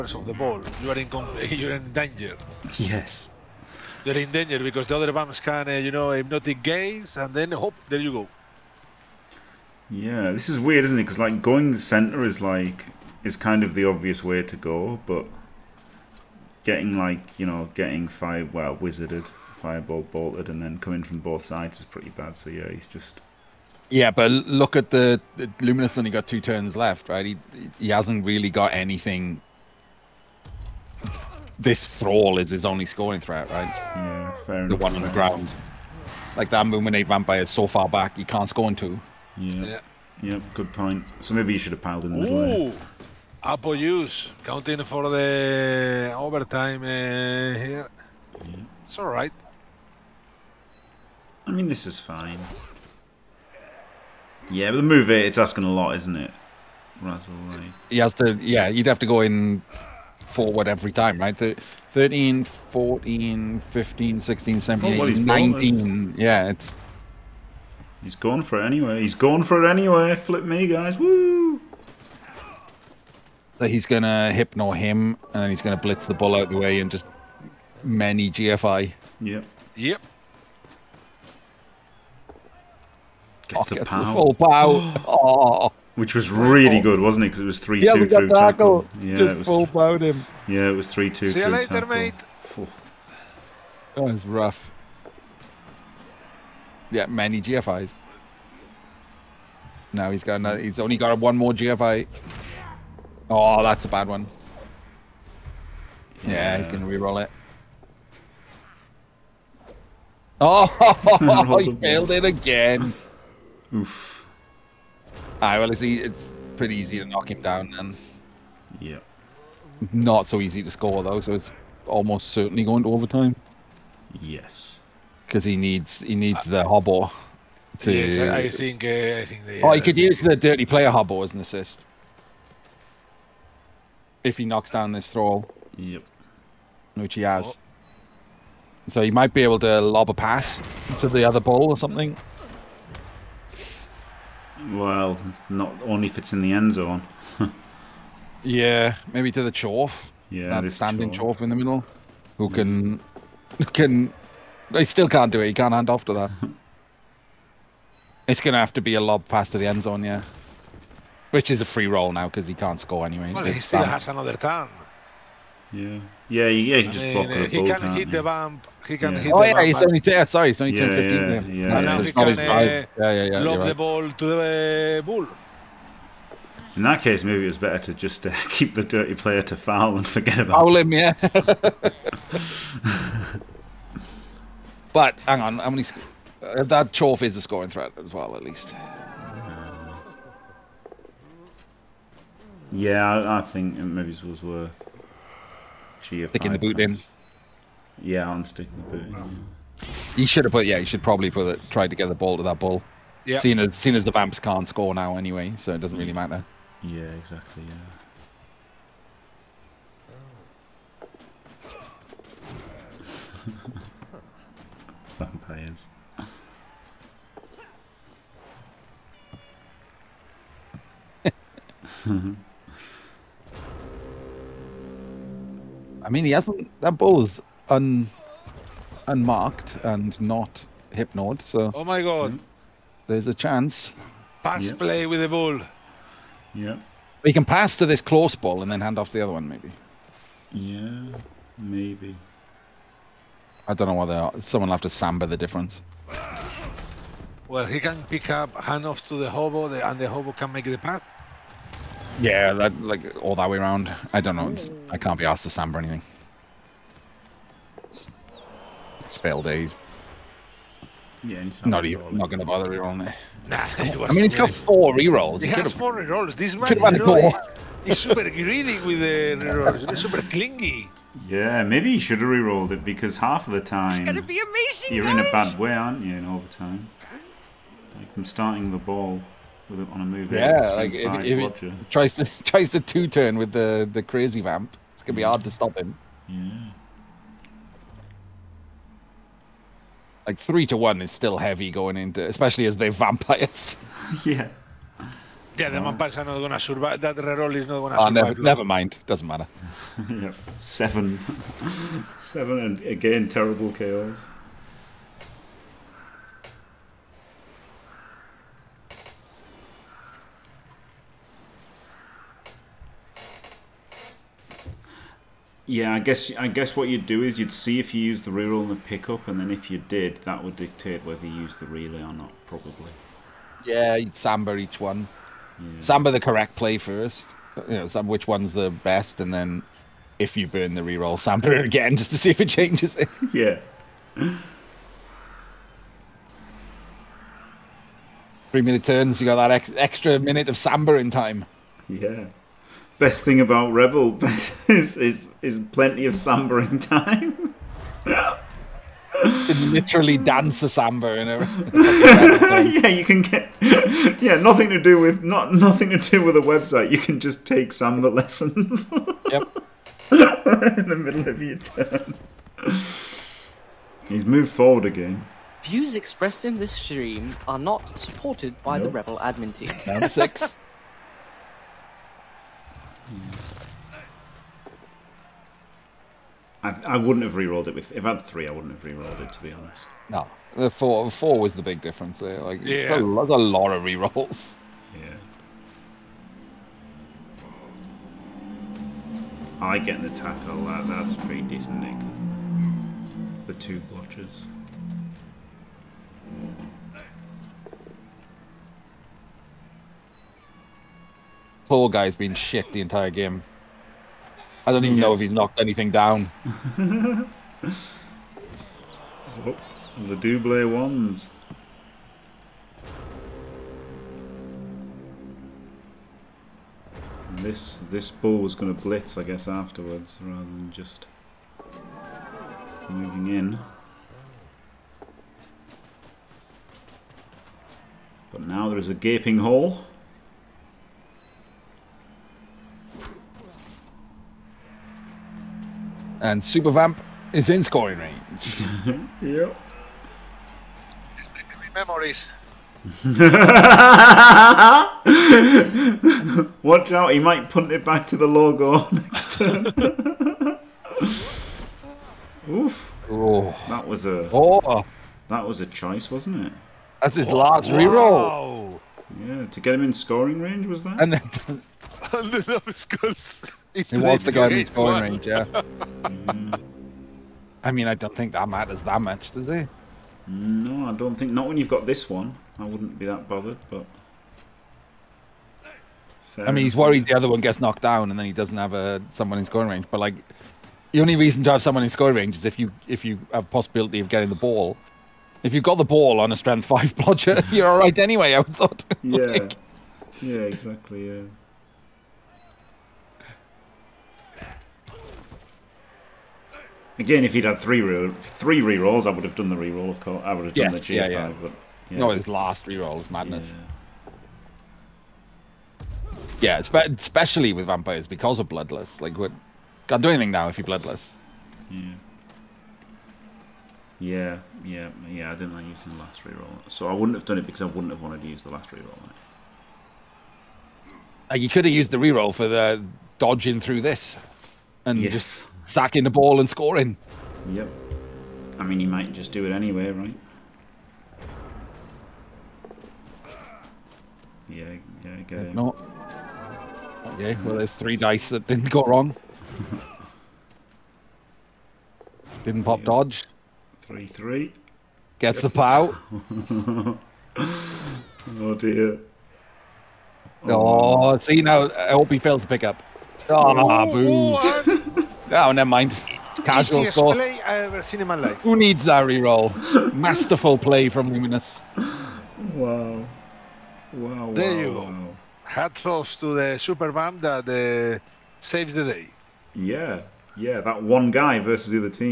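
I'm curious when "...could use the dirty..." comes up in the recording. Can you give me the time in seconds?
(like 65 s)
129 s.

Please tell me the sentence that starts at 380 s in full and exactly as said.
No, the four four was the big difference there.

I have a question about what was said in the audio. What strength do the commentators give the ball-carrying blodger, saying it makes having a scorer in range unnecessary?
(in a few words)
5.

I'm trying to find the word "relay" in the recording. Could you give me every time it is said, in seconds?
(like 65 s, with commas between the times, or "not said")
321 s.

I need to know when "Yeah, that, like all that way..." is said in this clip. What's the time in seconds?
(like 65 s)
252 s.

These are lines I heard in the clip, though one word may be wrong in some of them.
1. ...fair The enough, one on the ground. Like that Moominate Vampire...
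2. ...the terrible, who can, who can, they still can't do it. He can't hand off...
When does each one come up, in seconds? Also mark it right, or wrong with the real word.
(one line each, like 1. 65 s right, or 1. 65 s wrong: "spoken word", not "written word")
1. 34 s right
2. 151 s wrong: "middle", not "terrible".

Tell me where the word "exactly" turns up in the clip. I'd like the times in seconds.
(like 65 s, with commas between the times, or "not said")
207 s, 490 s.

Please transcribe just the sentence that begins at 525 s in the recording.
just sacking the ball and scoring.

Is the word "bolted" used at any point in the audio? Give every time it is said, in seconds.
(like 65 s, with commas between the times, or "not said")
20 s.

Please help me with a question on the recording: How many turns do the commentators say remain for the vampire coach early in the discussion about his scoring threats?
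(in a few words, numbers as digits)
2.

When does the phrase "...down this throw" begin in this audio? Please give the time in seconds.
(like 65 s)
134 s.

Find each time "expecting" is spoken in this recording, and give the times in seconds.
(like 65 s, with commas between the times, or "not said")
not said.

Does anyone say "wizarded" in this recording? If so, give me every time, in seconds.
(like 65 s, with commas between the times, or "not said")
18 s.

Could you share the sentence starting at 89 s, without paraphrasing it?
Yeah, Just it was, full bowed him.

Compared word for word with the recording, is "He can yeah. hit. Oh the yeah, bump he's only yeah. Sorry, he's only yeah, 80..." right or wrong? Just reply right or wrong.
wrong.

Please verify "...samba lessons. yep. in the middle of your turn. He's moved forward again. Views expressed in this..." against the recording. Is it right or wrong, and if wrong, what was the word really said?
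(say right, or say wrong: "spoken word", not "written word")
right.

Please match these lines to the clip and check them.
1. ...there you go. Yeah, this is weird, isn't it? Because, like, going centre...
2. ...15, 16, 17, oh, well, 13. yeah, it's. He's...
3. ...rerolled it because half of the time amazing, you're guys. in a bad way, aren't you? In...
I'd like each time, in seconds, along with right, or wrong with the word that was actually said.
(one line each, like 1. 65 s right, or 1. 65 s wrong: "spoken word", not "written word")
1. 7 s right
2. 63 s wrong: "19", not "13"
3. 272 s right.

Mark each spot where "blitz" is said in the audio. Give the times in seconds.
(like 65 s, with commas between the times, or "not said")
75 s, 418 s.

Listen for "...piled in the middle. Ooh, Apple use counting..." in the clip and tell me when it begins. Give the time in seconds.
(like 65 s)
41 s.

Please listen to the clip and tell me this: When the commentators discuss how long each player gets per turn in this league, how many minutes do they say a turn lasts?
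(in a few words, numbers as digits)
3.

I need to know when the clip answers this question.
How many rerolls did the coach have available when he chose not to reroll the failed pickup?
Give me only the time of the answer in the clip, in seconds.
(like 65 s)
265 s.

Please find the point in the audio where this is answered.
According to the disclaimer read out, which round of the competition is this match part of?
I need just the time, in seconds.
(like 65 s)
369 s.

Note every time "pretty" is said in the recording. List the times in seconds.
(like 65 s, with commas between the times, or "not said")
21 s, 116 s, 391 s.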